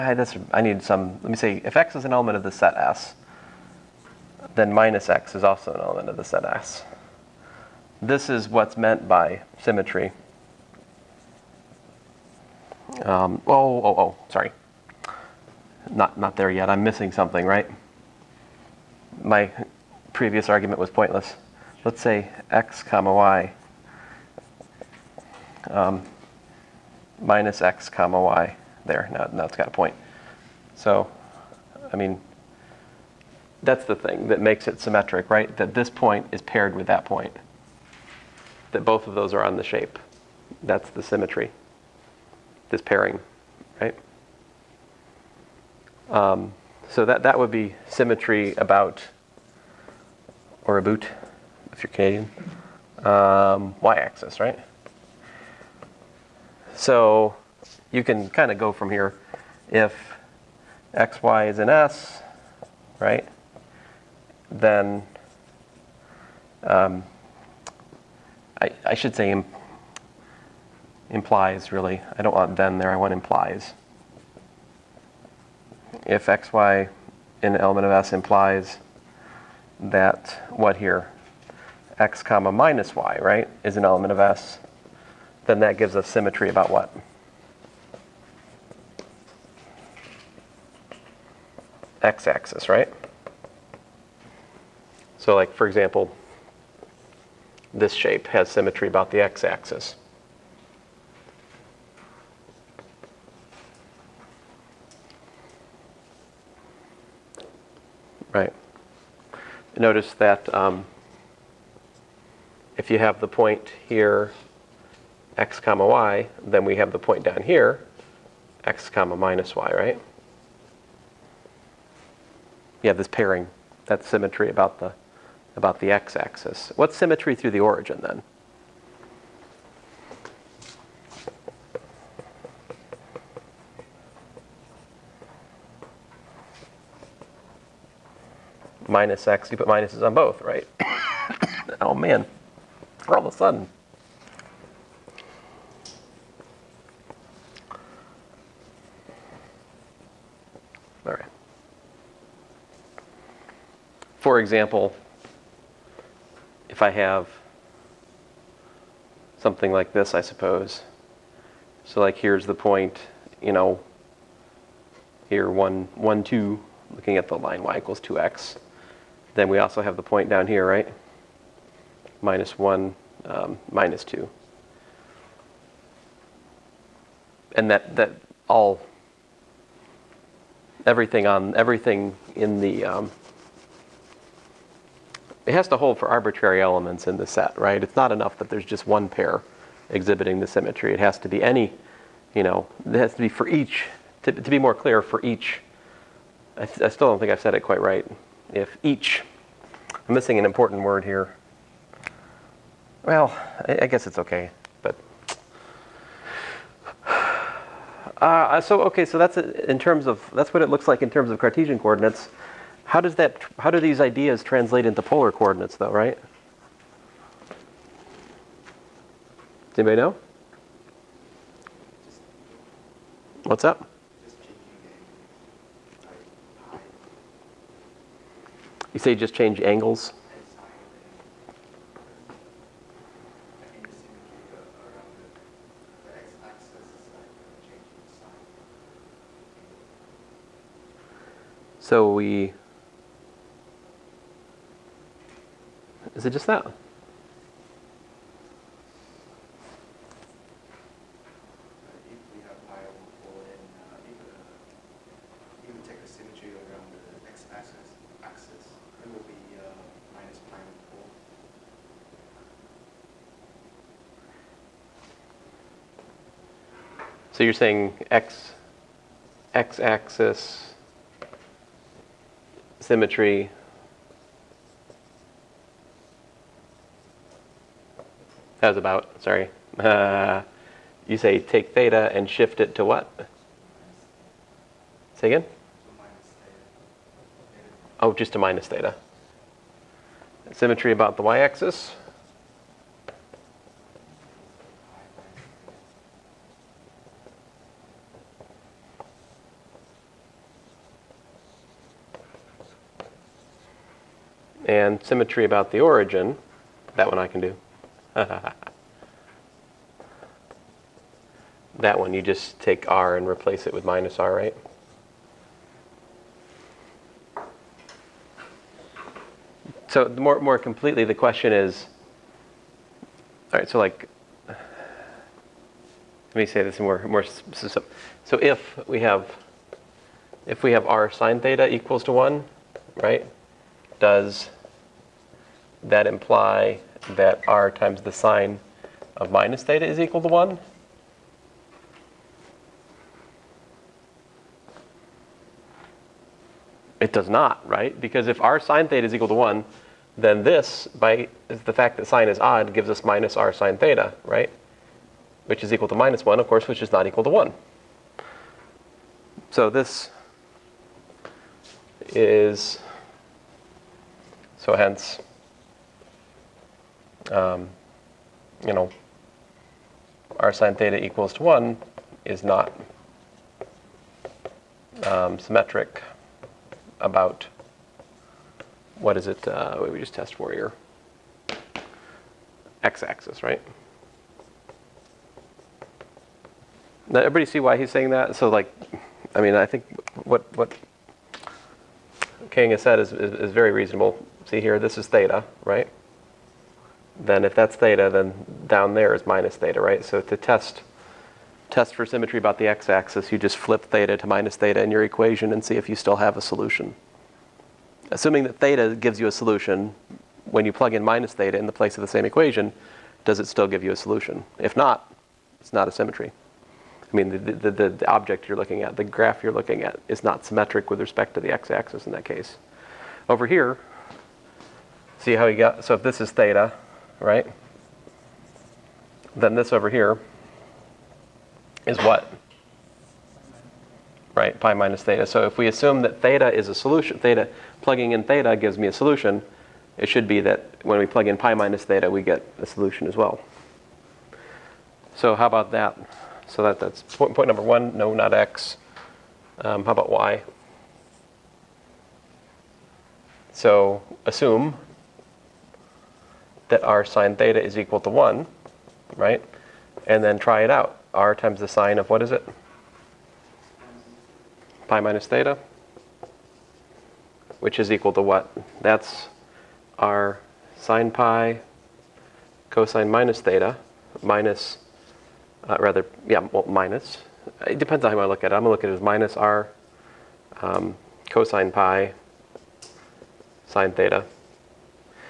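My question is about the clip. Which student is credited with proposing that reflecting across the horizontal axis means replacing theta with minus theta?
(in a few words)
King.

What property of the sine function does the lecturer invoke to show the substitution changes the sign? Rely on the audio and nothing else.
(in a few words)
sine is odd.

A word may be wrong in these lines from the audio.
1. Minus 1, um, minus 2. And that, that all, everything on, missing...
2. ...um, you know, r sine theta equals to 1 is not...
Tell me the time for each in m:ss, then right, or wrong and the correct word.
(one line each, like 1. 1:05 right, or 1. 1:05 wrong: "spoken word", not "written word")
1. 2:52 wrong: "everything", not "missing"
2. 6:07 right.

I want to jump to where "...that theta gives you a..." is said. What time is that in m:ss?
6:48.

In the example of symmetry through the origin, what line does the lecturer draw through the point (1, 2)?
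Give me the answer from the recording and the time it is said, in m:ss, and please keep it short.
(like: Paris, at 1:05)
y = 2x, at 2:47.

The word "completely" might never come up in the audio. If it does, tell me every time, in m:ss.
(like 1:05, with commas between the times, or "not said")
5:20.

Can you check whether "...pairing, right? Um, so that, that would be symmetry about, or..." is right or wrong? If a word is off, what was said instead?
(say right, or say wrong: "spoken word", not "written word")
right.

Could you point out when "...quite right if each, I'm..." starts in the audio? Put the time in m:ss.
3:17.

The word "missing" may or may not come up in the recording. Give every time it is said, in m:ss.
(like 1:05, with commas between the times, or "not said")
0:16, 3:20.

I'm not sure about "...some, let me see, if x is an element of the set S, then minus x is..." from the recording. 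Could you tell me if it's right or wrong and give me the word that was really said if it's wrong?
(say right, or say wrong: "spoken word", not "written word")
right.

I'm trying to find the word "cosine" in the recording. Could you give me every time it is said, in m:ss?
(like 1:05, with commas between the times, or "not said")
7:52, 8:01.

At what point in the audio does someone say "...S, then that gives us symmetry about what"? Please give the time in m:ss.
1:24.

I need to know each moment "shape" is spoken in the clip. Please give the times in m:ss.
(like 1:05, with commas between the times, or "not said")
0:39, 1:37.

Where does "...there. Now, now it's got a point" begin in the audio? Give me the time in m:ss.
0:28.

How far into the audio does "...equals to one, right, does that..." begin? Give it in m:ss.
5:31.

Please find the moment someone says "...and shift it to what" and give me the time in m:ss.
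4:42.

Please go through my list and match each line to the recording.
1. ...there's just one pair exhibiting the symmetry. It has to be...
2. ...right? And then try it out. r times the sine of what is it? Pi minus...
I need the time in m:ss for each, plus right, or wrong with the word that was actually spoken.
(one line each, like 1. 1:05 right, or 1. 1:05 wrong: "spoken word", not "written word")
1. 3:08 right
2. 7:39 right.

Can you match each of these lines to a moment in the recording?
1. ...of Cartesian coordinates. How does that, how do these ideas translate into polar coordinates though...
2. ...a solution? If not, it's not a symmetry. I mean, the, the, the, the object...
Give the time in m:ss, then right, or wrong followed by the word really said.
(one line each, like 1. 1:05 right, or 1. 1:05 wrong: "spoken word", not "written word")
1. 3:31 right
2. 6:53 right.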